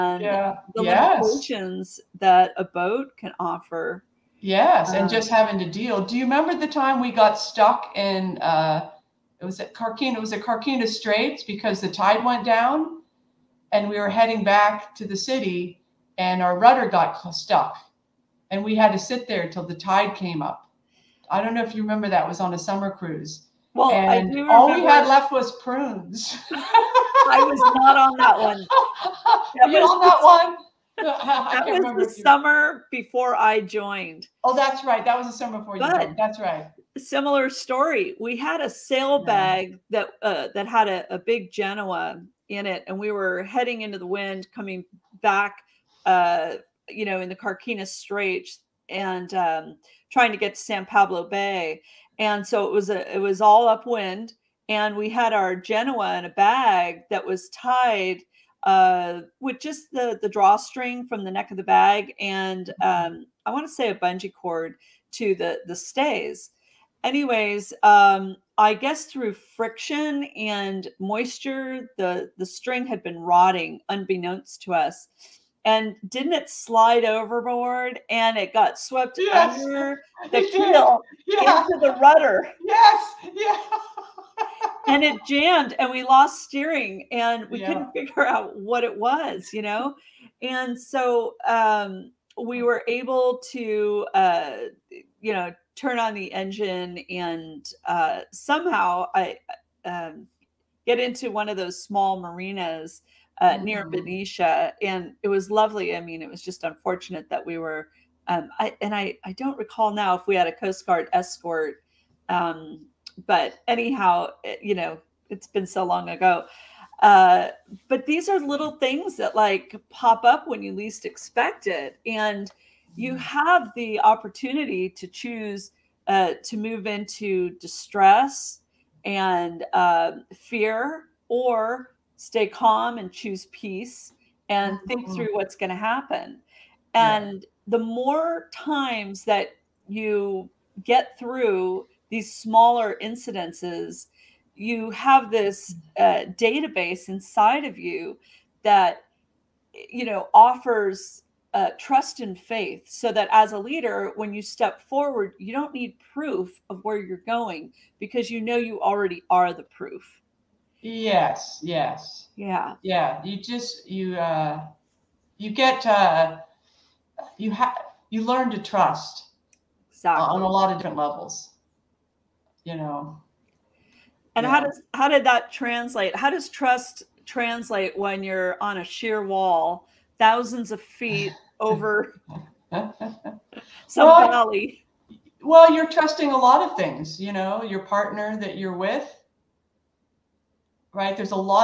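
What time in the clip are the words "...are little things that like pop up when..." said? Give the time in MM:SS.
01:58.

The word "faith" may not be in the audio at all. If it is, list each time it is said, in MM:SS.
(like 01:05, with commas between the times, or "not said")
02:32.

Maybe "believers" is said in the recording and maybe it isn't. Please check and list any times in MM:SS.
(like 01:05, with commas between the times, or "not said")
not said.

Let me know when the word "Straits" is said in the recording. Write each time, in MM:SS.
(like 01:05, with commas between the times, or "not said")
00:10, 00:47.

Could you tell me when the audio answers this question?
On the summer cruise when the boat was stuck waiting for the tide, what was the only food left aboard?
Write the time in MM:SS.
00:25.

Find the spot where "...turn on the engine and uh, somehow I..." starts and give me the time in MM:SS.
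01:35.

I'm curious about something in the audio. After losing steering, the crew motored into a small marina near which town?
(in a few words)
Benicia.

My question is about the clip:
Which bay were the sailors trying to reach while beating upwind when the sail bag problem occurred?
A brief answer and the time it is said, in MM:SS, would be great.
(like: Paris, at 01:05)
San Pablo Bay, at 00:50.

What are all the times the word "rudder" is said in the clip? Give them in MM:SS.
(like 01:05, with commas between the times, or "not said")
00:16, 01:22.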